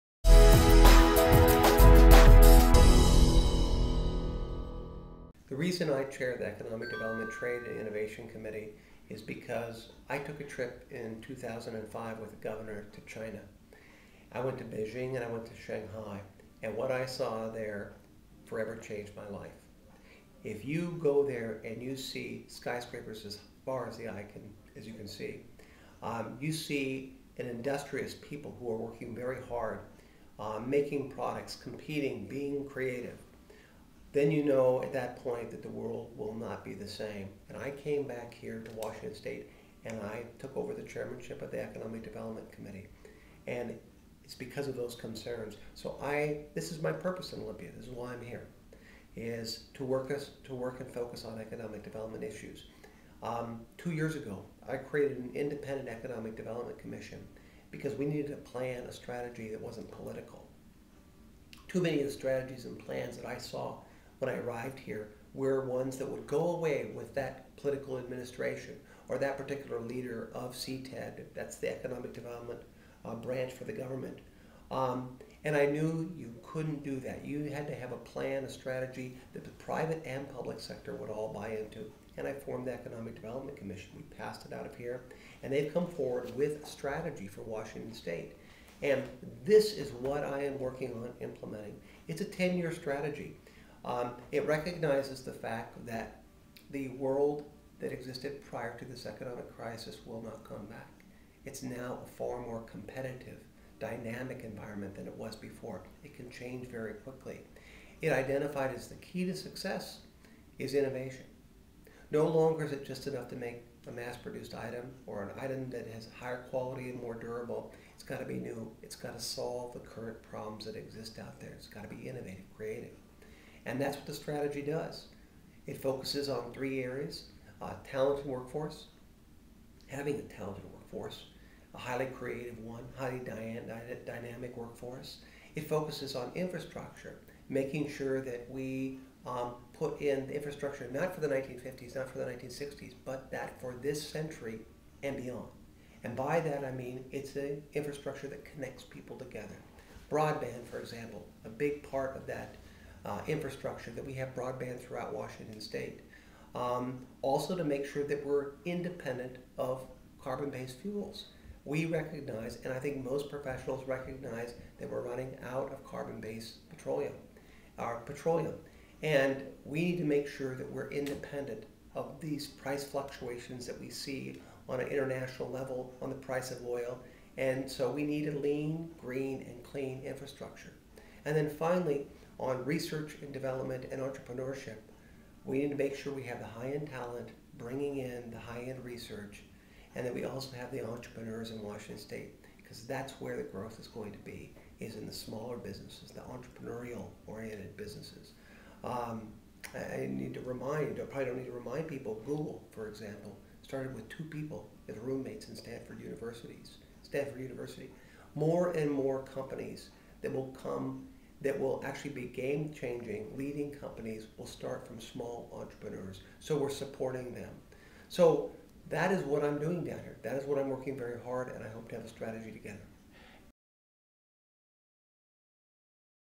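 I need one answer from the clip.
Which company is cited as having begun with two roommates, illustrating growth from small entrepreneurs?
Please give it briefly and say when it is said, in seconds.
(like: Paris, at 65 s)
Google, at 202 s.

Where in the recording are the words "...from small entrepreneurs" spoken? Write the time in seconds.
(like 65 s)
214 s.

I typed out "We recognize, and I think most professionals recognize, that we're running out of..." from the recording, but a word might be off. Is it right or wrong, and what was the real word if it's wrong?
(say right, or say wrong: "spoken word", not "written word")
right.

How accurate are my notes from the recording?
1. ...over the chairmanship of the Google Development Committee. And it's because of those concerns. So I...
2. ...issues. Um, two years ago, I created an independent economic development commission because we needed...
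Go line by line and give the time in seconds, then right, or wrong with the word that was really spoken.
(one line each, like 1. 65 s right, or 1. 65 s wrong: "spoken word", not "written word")
1. 40 s wrong: "Economic", not "Google"
2. 52 s right.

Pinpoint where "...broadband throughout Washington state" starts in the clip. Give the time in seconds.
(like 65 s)
154 s.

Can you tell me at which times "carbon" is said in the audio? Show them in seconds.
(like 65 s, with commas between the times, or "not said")
160 s, 165 s.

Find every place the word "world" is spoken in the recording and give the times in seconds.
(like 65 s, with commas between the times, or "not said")
35 s, 96 s.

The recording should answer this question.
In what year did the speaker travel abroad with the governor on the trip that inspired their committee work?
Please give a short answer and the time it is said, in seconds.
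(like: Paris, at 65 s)
2005, at 11 s.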